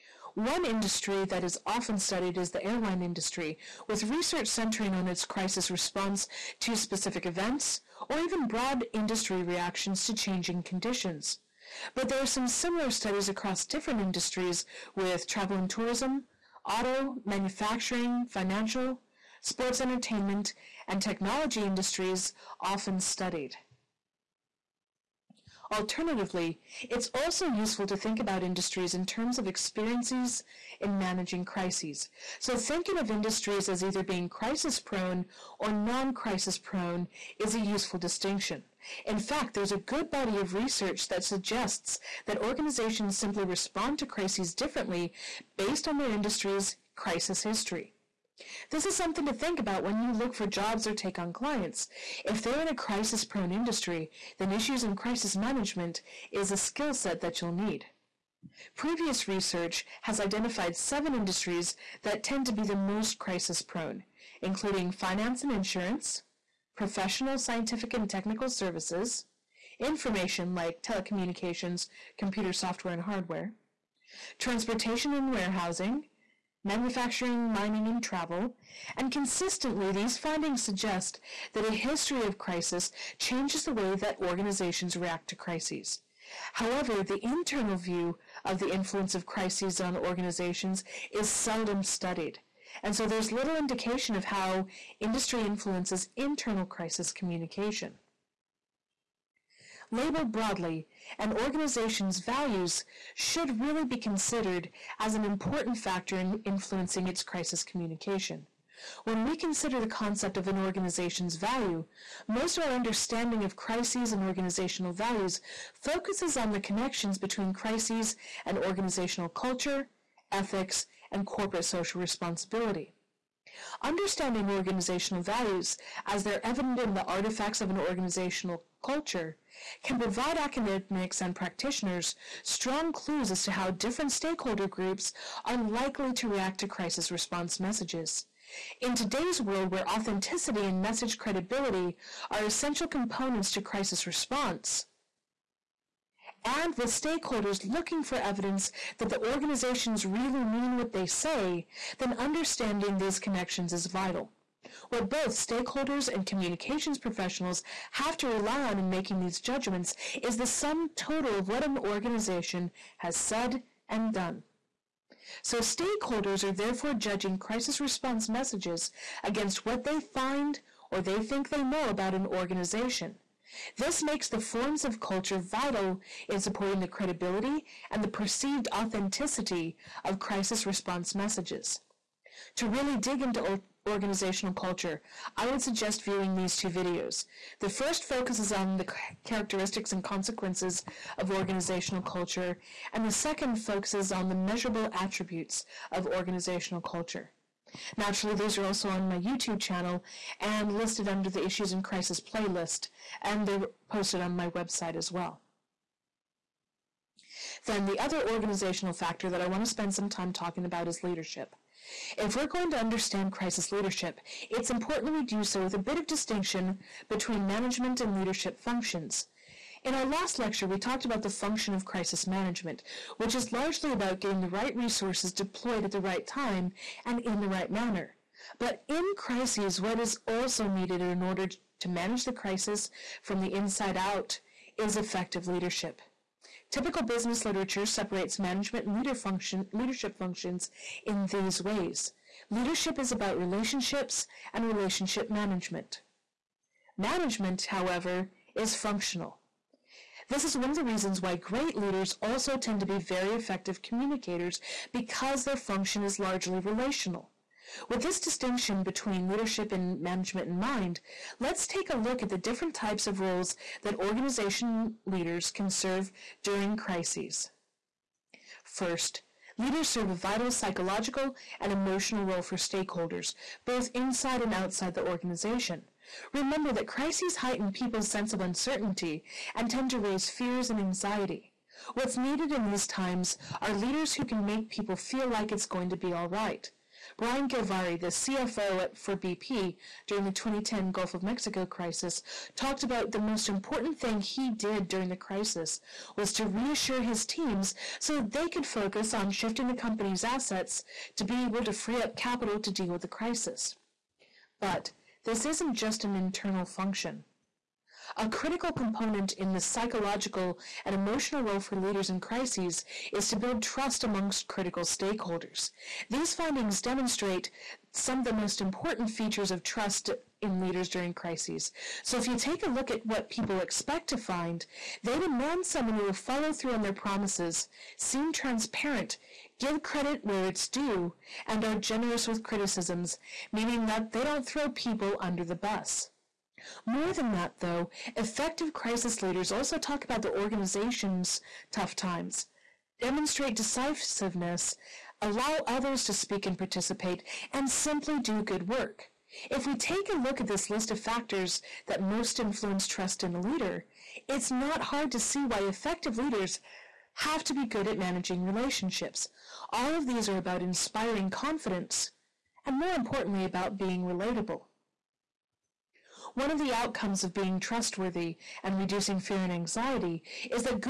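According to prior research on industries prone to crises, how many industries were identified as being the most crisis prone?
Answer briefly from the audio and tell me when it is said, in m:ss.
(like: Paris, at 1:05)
7, at 1:00.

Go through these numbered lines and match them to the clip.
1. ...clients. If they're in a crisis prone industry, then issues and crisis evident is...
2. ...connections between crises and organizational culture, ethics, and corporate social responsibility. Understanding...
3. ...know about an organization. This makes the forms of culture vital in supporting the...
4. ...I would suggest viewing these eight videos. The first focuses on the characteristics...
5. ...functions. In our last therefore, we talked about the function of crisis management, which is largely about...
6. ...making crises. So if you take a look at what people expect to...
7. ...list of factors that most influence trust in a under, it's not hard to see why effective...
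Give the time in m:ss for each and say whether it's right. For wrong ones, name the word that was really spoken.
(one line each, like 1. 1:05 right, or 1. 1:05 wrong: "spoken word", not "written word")
1. 0:51 wrong: "management", not "evident"
2. 1:56 right
3. 2:51 right
4. 3:05 wrong: "two", not "eight"
5. 3:38 wrong: "lecture", not "therefore"
6. 5:20 wrong: "during", not "making"
7. 5:50 wrong: "leader", not "under".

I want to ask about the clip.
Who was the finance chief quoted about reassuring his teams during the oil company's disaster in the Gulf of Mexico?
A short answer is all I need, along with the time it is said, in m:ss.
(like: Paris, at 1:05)
Brian Gilvary, at 4:47.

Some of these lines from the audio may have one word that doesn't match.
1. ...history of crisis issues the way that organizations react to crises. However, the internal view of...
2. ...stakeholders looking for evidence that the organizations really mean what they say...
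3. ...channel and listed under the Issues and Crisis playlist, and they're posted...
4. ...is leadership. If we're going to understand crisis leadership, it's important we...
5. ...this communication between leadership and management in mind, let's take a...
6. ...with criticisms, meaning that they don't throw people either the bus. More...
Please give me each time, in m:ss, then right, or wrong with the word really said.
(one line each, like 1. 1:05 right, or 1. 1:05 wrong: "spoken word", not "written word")
1. 1:21 wrong: "changes", not "issues"
2. 2:26 right
3. 3:19 right
4. 3:30 right
5. 4:18 wrong: "distinction", not "communication"
6. 5:32 wrong: "under", not "either".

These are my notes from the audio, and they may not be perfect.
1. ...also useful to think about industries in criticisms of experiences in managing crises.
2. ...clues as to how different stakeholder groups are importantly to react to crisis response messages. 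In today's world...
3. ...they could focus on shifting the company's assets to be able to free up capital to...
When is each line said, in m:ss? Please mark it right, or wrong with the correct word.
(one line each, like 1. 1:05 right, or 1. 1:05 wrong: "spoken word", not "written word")
1. 0:27 wrong: "terms", not "criticisms"
2. 2:12 wrong: "likely", not "importantly"
3. 4:58 right.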